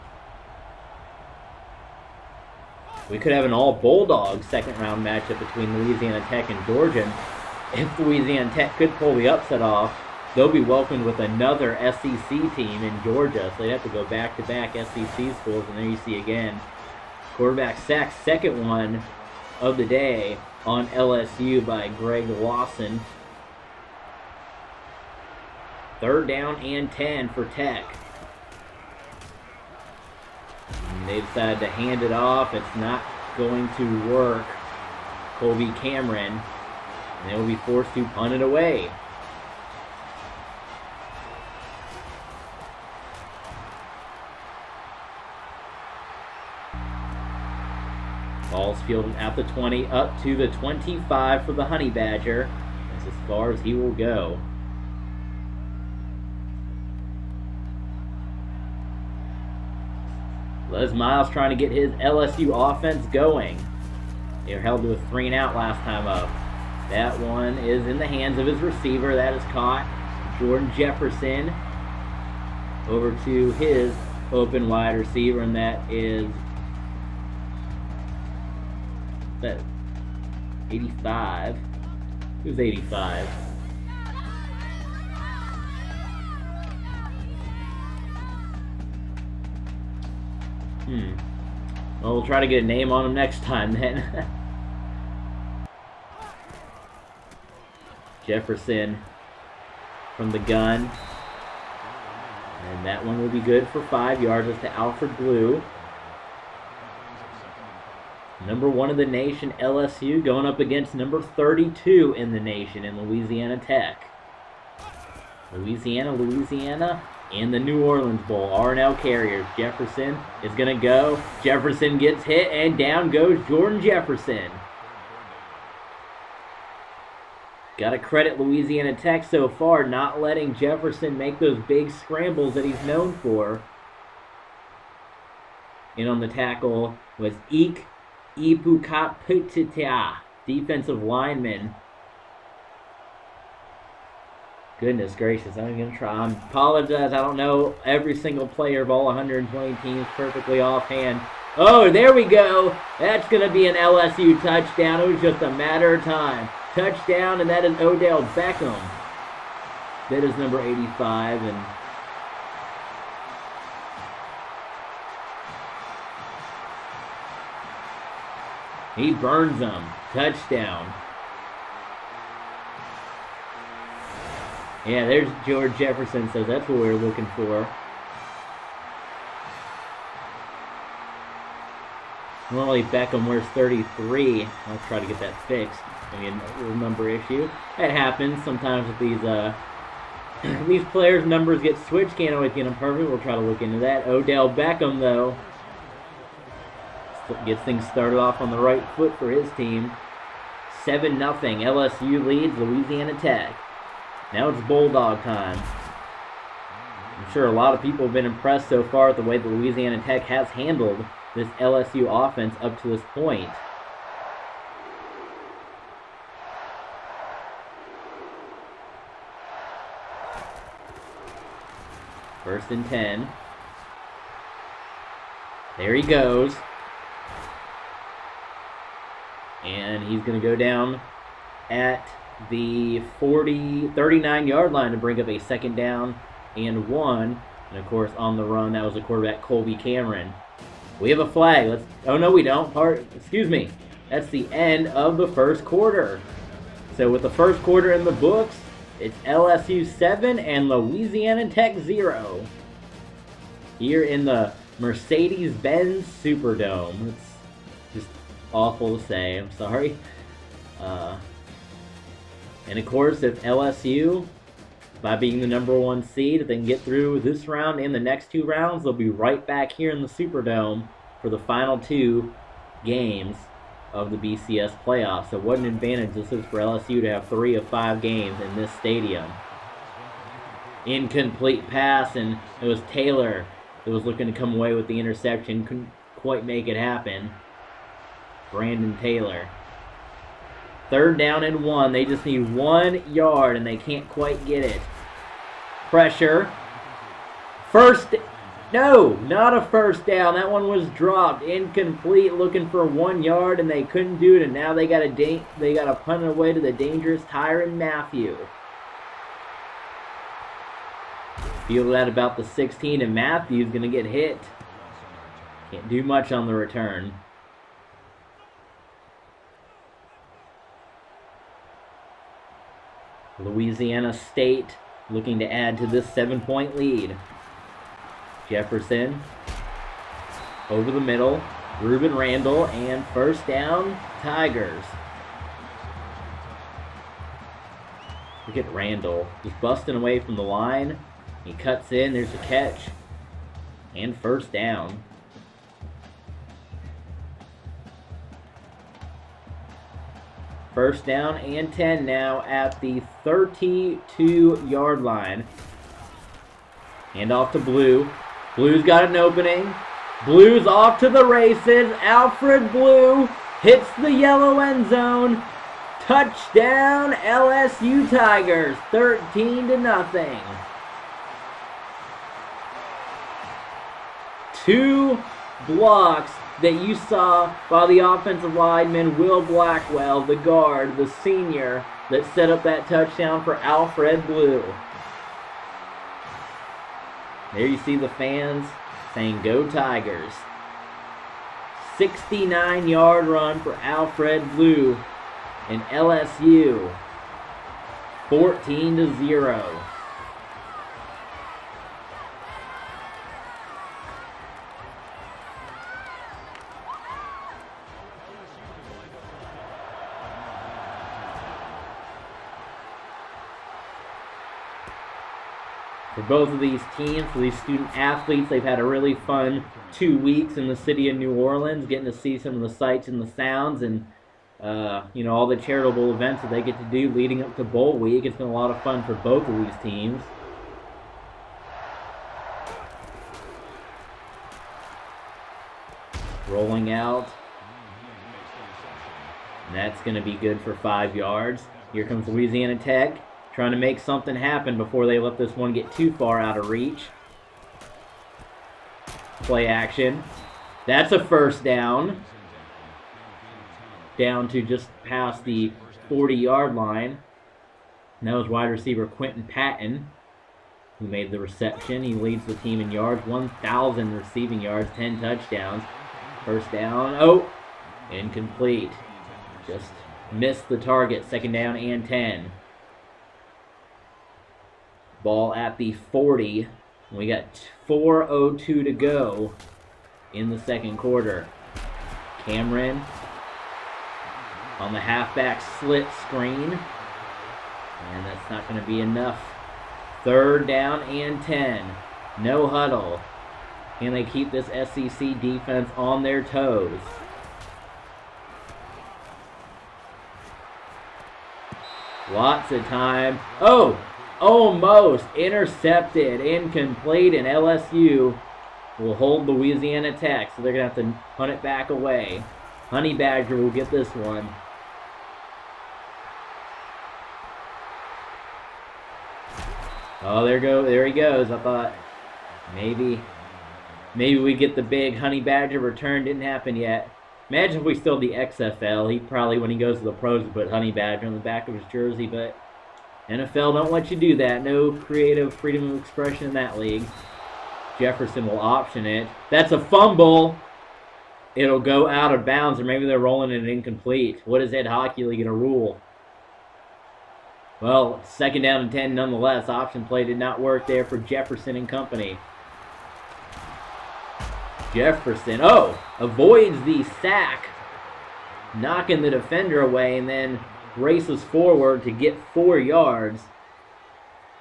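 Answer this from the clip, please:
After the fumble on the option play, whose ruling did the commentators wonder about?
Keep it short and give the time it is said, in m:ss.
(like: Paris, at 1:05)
Ed Hochuli, at 9:04.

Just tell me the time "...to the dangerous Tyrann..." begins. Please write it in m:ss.
5:06.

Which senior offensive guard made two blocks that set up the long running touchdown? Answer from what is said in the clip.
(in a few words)
Will Blackwell.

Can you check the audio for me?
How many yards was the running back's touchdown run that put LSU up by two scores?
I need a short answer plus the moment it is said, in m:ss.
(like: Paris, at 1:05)
69, at 6:31.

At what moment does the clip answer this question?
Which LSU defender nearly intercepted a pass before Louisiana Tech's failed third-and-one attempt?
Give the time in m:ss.
4:48.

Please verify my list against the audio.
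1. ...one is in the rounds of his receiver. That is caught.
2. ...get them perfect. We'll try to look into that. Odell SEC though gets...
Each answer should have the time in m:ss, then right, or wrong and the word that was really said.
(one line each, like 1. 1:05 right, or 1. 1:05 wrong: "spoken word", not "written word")
1. 1:07 wrong: "hands", not "rounds"
2. 3:12 wrong: "Beckham", not "SEC".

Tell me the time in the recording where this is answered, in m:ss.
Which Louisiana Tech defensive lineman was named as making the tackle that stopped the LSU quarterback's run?
2:17.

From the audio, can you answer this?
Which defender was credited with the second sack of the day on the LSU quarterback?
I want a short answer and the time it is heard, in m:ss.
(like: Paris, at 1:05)
Greg Lawson, at 0:21.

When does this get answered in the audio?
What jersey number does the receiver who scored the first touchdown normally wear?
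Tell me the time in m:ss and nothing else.
3:03.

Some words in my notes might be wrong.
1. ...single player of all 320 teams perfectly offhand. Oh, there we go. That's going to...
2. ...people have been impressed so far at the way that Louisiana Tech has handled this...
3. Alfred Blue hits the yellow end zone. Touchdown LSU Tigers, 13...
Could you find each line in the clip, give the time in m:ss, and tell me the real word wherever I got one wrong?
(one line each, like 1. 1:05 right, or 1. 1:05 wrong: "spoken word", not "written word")
1. 2:28 wrong: "120", not "320"
2. 3:27 right
3. 6:02 right.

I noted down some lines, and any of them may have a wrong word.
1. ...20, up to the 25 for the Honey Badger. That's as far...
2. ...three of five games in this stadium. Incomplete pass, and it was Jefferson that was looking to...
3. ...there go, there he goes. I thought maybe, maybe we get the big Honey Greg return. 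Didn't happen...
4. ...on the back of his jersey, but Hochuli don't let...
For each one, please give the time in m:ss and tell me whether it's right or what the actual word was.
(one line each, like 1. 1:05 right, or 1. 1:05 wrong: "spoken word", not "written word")
1. 0:49 right
2. 4:37 wrong: "Taylor", not "Jefferson"
3. 8:40 wrong: "Badger", not "Greg"
4. 8:51 wrong: "NFL", not "Hochuli".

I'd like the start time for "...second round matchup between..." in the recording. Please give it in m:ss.
0:04.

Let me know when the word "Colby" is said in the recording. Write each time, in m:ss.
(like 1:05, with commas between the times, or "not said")
0:35, 3:59.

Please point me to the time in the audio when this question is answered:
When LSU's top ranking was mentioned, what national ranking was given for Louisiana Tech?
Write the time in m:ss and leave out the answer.
1:51.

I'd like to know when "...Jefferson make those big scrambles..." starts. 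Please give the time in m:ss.
2:10.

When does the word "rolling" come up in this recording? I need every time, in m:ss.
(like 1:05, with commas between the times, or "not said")
7:16, 9:03.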